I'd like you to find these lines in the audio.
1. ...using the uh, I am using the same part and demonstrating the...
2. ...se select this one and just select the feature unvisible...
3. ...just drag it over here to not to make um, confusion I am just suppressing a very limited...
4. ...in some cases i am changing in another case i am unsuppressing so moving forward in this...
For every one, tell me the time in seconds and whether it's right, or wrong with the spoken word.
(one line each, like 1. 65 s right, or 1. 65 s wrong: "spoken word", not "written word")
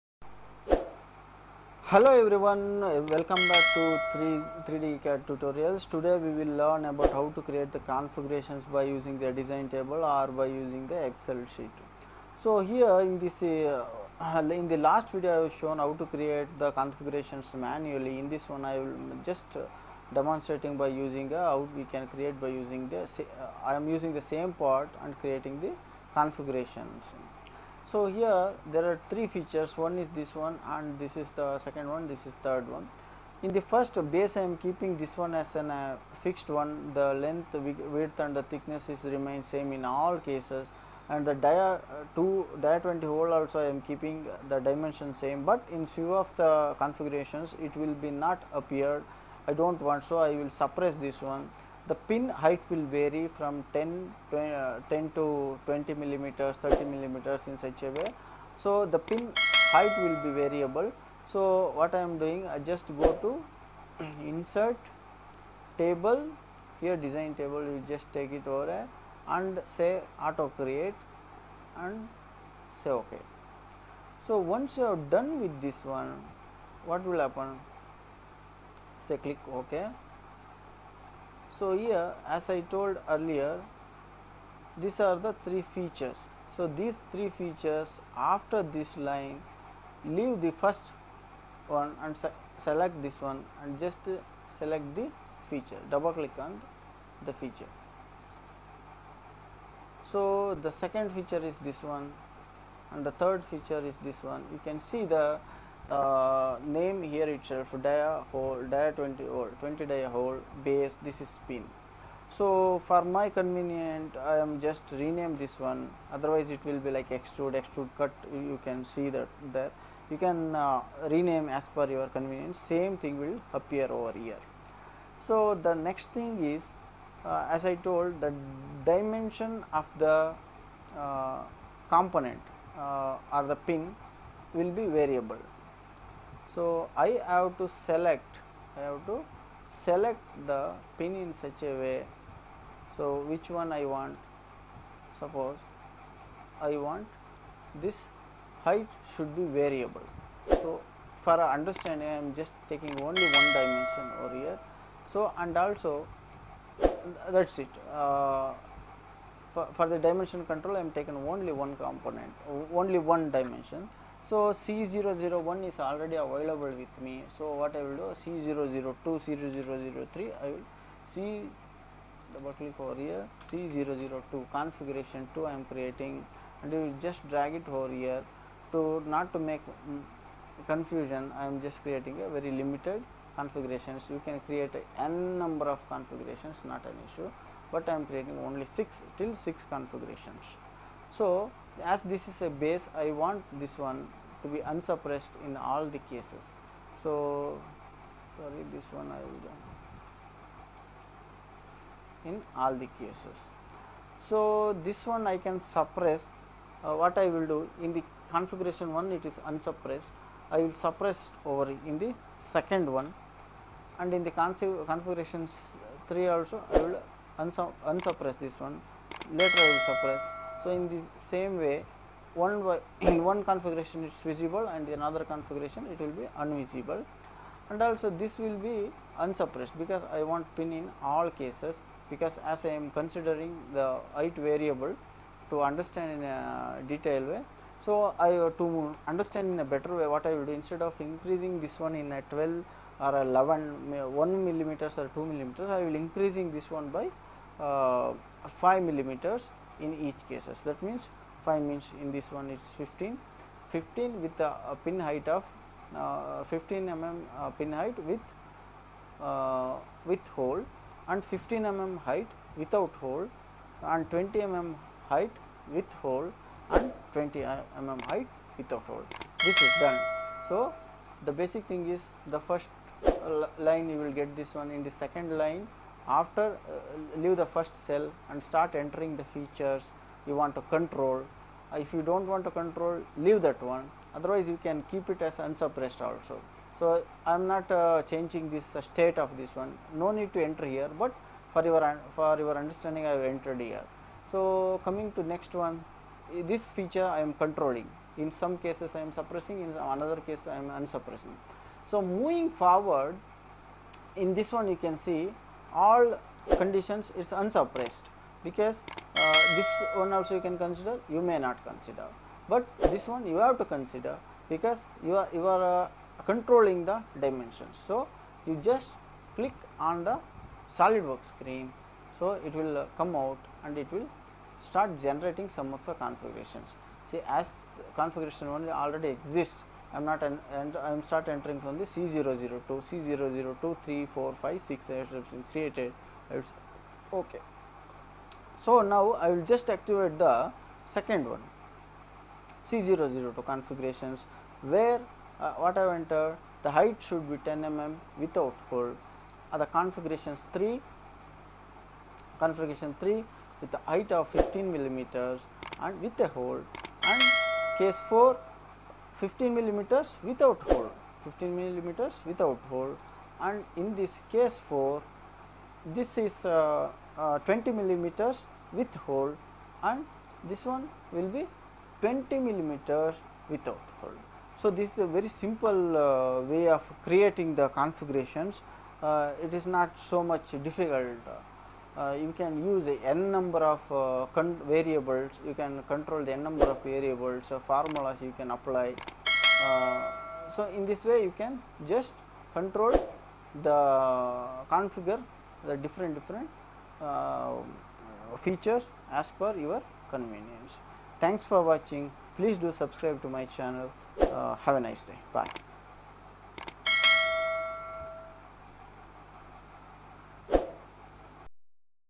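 1. 22 s wrong: "creating", not "demonstrating"
2. 92 s wrong: "double", not "unvisible"
3. 177 s wrong: "creating", not "suppressing"
4. 298 s wrong: "suppressing", not "changing".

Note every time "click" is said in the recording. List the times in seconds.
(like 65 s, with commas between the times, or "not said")
79 s, 96 s, 172 s, 319 s.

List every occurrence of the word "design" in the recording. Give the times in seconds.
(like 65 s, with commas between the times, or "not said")
9 s, 66 s.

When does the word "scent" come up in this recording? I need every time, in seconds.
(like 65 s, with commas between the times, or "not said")
not said.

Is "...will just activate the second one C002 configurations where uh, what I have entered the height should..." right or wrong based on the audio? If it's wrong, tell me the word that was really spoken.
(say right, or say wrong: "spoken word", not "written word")
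right.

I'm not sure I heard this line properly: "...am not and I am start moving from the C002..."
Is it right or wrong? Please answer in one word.
wrong.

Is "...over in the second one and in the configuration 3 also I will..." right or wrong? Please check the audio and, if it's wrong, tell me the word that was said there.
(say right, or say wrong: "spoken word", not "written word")
right.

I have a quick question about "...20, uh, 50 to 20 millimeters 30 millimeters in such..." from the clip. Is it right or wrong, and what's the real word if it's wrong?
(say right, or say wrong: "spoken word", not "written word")
wrong: "10", not "50".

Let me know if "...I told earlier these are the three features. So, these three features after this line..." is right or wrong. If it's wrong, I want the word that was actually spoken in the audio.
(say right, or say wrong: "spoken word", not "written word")
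right.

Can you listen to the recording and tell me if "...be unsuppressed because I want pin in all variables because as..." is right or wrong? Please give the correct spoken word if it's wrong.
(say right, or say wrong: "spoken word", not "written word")
wrong: "cases", not "variables".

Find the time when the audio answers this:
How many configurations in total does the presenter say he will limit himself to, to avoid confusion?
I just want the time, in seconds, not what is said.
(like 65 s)
189 s.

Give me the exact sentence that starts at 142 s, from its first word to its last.
So, which one I want suppose I want this height should be variable.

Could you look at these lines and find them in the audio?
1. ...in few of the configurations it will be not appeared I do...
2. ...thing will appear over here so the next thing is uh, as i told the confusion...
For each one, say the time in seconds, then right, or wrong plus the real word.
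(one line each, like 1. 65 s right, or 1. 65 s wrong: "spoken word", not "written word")
1. 45 s right
2. 123 s wrong: "dimension", not "confusion".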